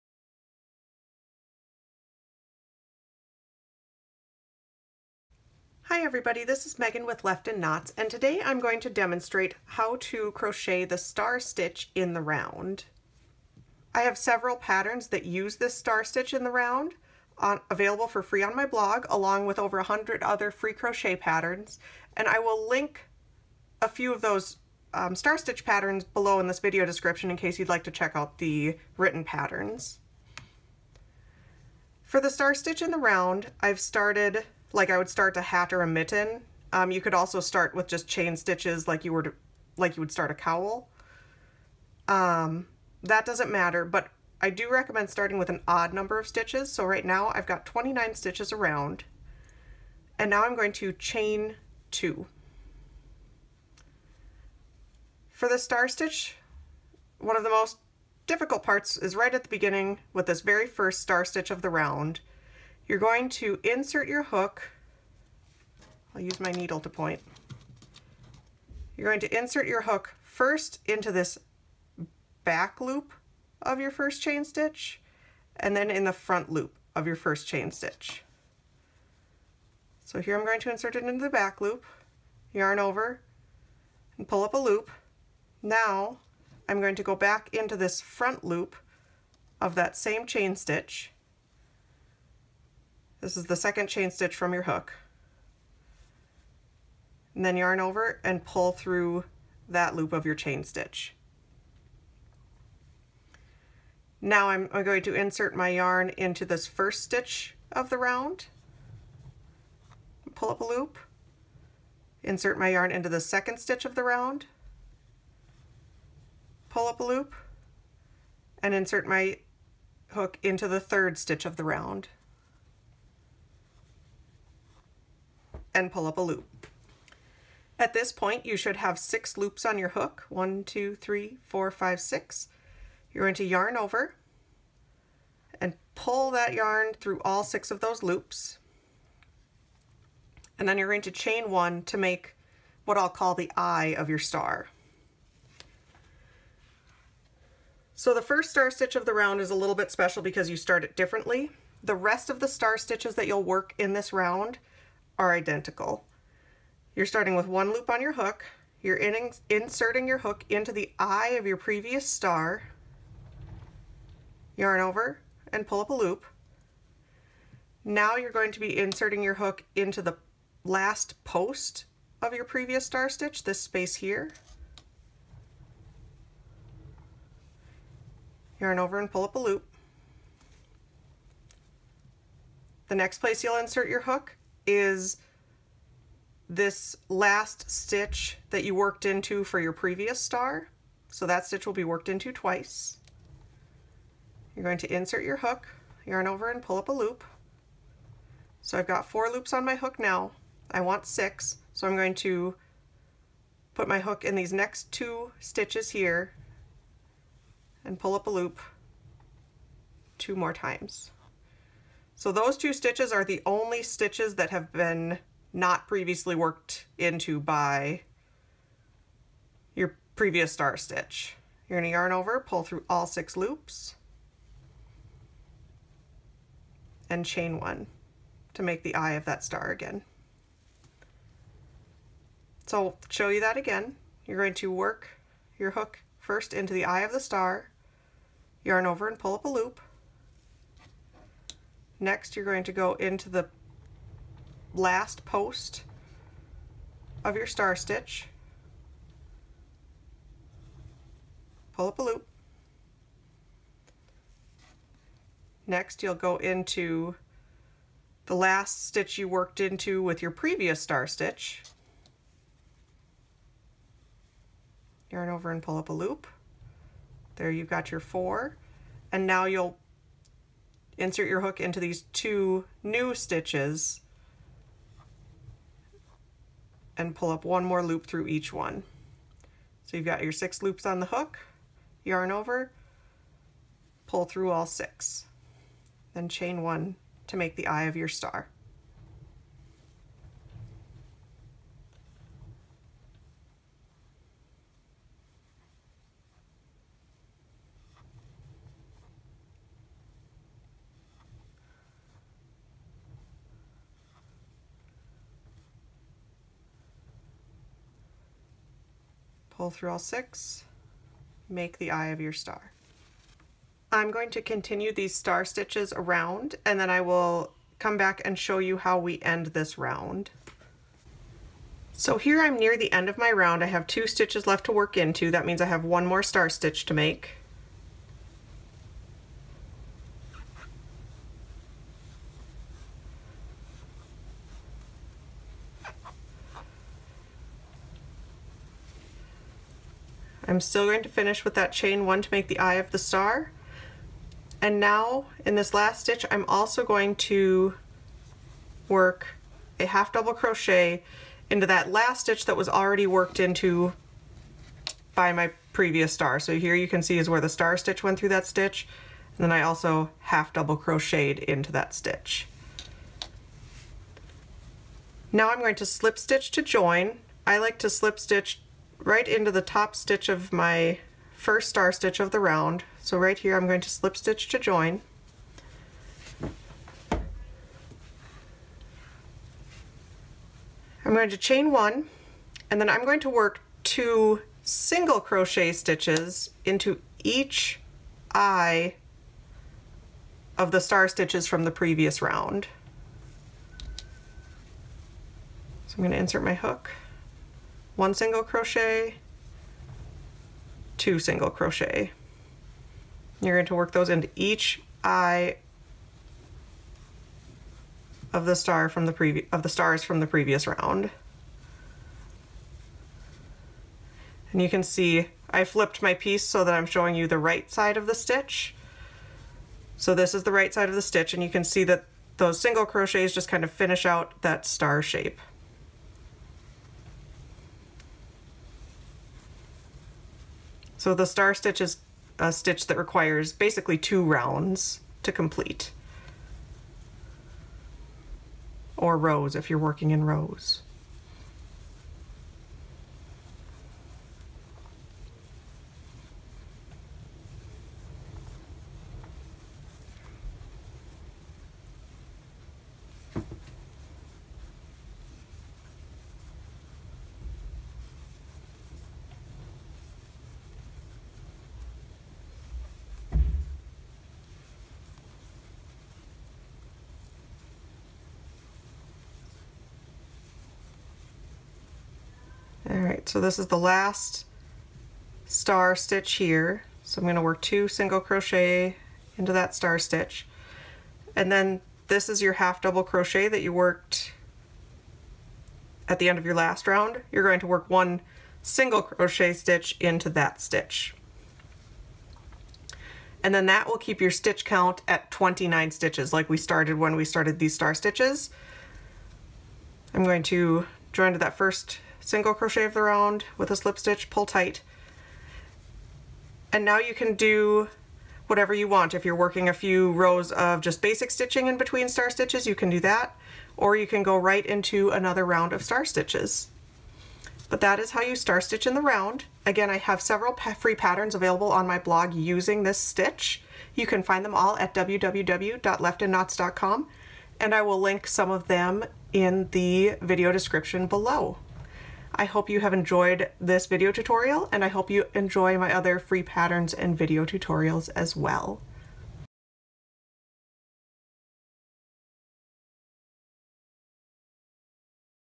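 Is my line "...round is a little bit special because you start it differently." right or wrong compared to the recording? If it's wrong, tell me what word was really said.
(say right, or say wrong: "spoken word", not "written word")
right.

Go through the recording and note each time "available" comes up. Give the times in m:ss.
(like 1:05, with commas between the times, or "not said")
0:17, 8:41.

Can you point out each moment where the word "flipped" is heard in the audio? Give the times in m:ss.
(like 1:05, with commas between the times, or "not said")
6:55.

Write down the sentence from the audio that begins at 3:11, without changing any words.
So that stitch will be worked into twice.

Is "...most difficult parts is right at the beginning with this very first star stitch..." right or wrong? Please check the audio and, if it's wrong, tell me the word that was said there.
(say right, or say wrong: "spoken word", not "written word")
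right.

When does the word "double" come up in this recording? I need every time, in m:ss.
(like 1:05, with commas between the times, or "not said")
5:50, 6:00, 8:02.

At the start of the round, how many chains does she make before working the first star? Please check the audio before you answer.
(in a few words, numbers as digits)
2.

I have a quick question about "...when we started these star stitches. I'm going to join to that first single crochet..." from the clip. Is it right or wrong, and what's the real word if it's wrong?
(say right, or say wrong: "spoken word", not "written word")
right.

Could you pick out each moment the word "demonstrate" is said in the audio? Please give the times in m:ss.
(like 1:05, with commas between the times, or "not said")
0:08.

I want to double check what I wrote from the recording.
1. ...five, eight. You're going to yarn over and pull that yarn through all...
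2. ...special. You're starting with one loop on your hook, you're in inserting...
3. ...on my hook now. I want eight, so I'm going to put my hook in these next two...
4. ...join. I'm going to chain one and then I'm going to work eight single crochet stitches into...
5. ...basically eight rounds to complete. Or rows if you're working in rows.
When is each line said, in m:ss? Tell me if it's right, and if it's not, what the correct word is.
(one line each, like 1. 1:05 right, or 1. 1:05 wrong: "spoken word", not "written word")
1. 2:11 wrong: "six", not "eight"
2. 2:35 wrong: "identical", not "special"
3. 3:19 wrong: "six", not "eight"
4. 6:14 wrong: "two", not "eight"
5. 7:13 wrong: "two", not "eight".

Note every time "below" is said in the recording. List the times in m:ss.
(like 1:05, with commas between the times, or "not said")
0:26, 8:51.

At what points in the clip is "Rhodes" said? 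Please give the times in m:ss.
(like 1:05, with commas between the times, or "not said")
not said.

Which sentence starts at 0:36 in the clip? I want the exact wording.
Um, you could also start with just chain stitches like you were to, like you would start a cowl.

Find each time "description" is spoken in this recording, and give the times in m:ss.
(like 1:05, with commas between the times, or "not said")
0:26, 8:50.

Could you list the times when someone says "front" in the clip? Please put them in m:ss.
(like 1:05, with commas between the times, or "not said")
1:16, 1:28.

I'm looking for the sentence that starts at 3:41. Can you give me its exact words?
You're gonna yarn over, pull through all six loops, and chain one to make the eye of that star again.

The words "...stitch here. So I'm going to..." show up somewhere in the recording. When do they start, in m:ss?
7:55.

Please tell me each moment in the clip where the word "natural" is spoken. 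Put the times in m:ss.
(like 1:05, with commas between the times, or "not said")
not said.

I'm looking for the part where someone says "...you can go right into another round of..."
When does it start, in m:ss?
8:33.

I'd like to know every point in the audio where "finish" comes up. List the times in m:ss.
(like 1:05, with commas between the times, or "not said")
5:41, 7:03.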